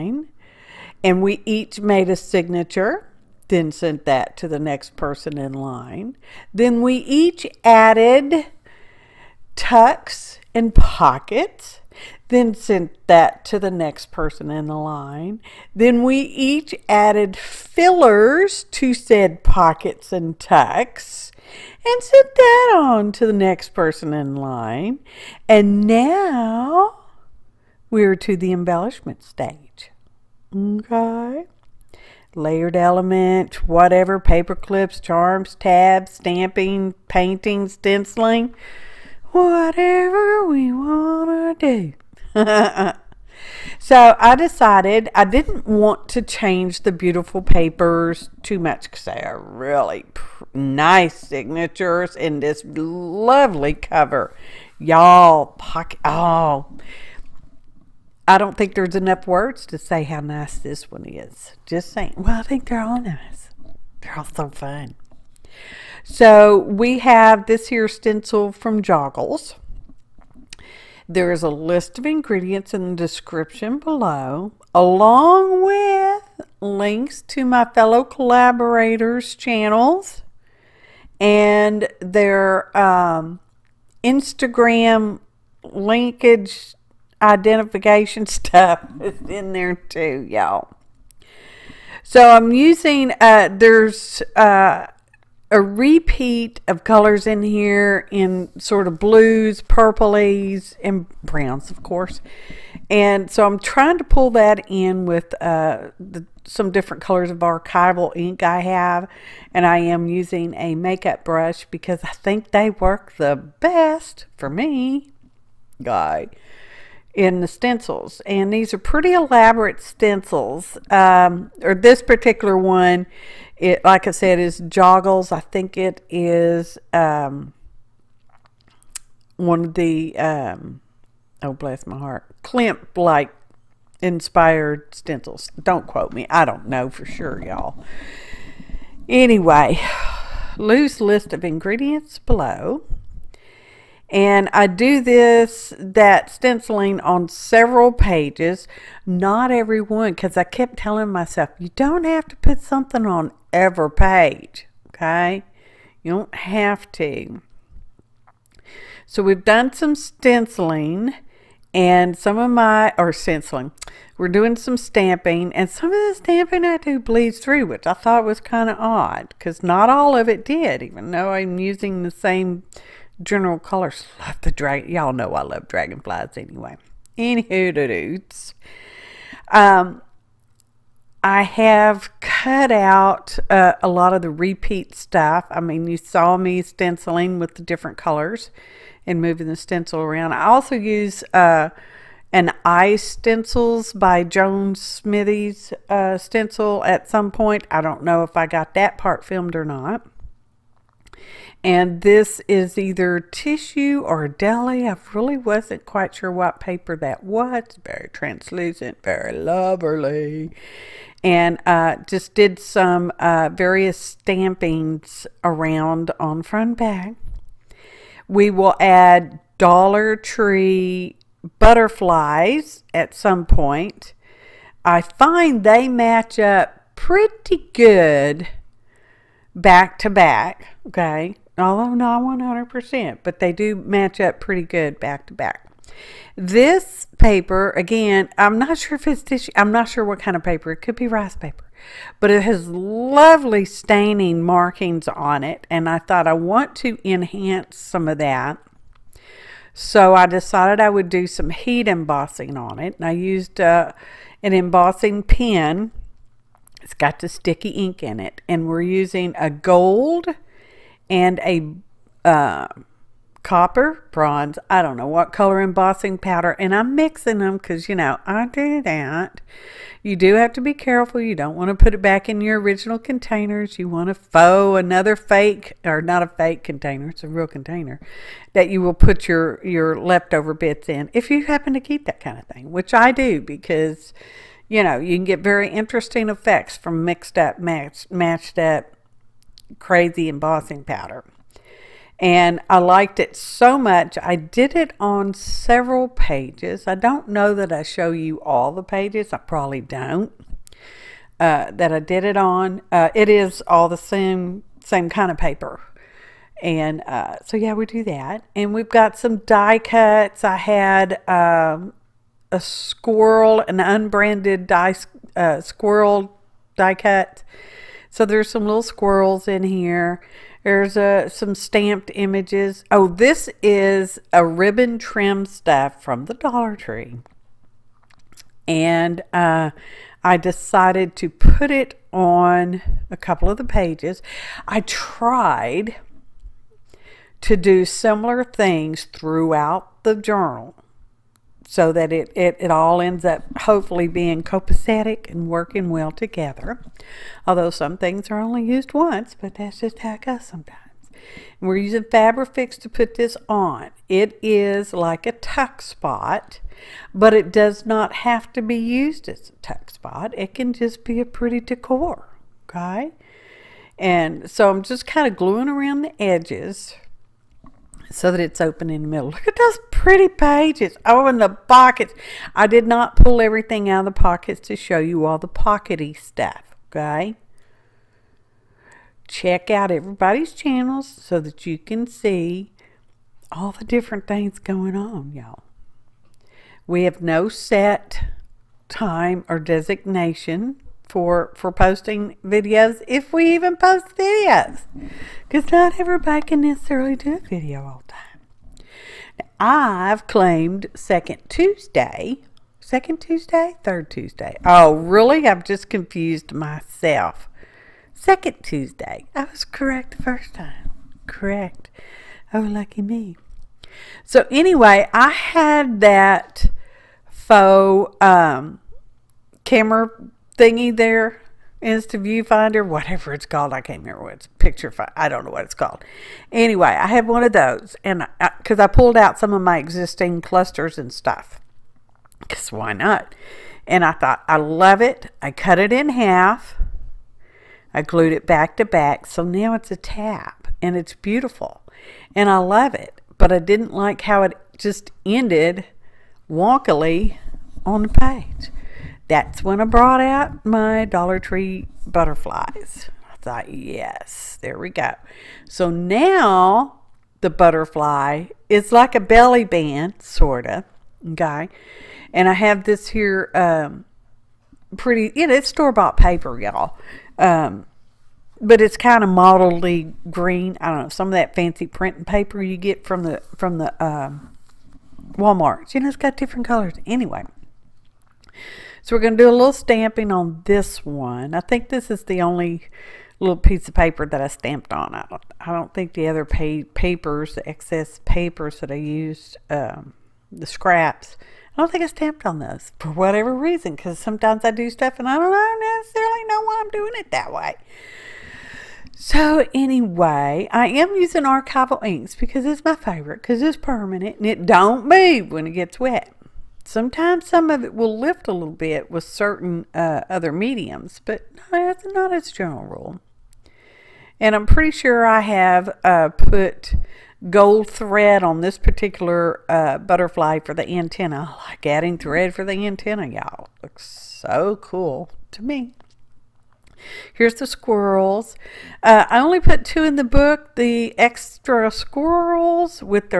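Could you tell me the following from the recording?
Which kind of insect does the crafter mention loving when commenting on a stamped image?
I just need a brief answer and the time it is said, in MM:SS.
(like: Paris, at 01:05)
Dragonflies, at 02:55.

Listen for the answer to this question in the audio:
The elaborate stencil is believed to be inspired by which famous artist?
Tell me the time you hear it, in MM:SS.
02:12.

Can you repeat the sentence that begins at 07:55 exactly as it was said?
You know, it's got different colors.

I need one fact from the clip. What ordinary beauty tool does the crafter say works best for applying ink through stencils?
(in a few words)
Makeup brush.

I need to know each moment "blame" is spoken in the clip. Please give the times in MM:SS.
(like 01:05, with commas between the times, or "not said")
not said.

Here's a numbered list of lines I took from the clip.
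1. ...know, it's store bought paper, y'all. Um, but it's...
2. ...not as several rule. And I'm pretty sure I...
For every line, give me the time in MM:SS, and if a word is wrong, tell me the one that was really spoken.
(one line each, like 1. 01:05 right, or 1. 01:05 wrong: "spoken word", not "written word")
1. 07:45 right
2. 08:32 wrong: "general", not "several".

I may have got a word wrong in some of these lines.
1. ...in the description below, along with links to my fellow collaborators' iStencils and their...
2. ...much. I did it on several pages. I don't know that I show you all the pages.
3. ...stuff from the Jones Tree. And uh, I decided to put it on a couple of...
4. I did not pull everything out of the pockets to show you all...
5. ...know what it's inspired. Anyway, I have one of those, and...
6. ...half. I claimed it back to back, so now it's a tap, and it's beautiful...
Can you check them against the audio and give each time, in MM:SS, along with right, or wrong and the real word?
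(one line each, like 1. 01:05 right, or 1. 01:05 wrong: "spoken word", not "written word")
1. 01:12 wrong: "channels", not "iStencils"
2. 04:53 right
3. 05:25 wrong: "Dollar", not "Jones"
4. 06:12 right
5. 07:05 wrong: "called", not "inspired"
6. 07:16 wrong: "glued", not "claimed".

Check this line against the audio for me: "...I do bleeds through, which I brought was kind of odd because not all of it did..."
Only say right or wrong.
wrong.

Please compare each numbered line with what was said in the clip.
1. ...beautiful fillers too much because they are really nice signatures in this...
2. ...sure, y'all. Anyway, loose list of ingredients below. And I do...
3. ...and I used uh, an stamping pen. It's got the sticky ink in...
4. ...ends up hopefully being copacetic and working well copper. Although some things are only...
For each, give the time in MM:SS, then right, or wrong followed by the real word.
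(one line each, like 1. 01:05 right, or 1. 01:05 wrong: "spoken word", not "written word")
1. 00:46 wrong: "papers", not "fillers"
2. 02:17 right
3. 04:12 wrong: "embossing", not "stamping"
4. 05:43 wrong: "together", not "copper".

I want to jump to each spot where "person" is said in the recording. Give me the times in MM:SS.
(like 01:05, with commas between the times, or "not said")
00:04, 00:14, 00:23.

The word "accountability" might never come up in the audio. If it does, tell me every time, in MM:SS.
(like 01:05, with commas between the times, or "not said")
not said.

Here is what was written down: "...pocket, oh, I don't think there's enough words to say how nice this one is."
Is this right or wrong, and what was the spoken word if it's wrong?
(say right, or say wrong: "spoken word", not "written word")
right.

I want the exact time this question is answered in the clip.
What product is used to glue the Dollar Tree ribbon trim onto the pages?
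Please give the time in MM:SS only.
05:52.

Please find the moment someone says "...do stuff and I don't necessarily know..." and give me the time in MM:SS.
08:14.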